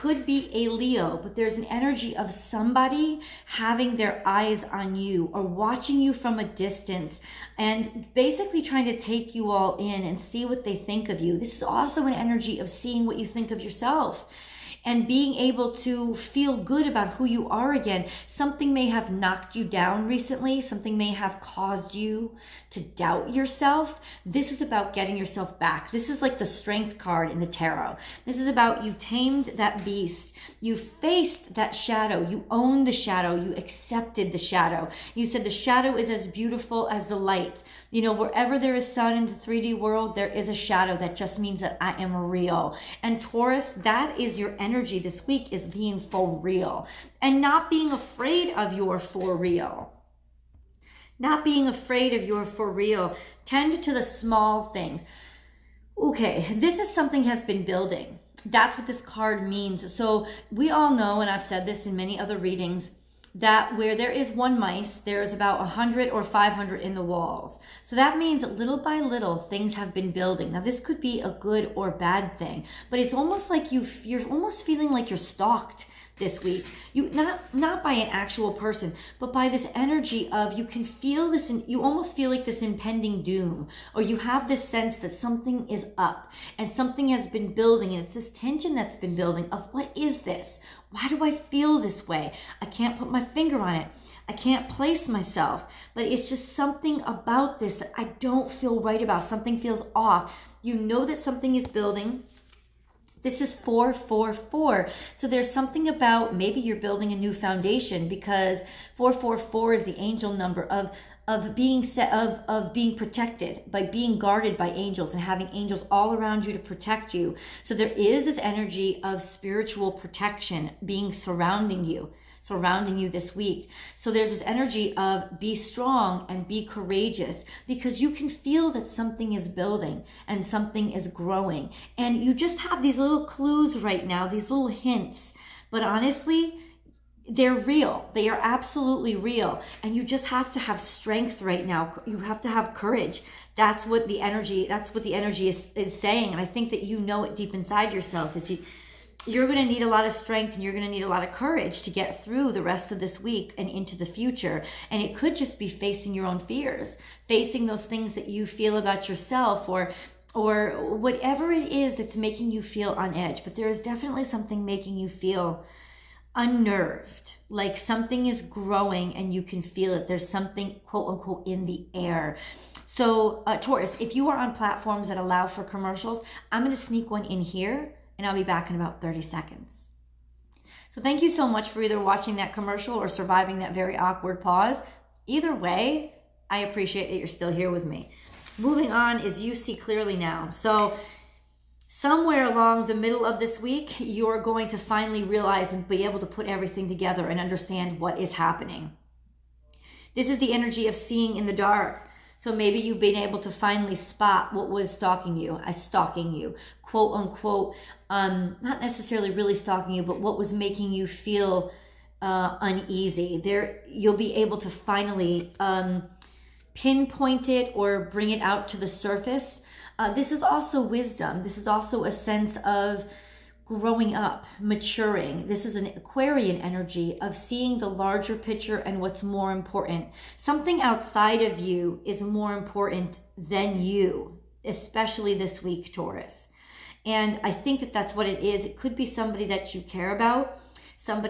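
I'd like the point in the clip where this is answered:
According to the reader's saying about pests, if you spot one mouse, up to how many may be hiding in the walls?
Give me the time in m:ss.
1:06.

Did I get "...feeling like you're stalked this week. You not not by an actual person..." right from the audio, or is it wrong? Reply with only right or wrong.
right.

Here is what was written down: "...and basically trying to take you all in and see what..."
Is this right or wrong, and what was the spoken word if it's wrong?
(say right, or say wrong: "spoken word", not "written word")
right.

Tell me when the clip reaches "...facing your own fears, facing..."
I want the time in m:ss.
2:35.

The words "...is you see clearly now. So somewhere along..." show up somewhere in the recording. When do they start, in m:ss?
3:09.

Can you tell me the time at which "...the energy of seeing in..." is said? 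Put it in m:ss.
3:20.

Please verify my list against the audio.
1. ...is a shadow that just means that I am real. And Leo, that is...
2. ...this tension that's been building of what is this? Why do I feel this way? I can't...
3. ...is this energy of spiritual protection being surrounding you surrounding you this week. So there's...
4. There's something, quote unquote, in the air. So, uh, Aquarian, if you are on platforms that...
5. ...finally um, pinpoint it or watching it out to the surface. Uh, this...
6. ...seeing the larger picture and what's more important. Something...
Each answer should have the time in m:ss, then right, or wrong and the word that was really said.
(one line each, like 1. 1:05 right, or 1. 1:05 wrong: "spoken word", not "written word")
1. 0:40 wrong: "Taurus", not "Leo"
2. 1:28 right
3. 1:57 right
4. 2:50 wrong: "Taurus", not "Aquarian"
5. 3:34 wrong: "bring", not "watching"
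6. 3:47 right.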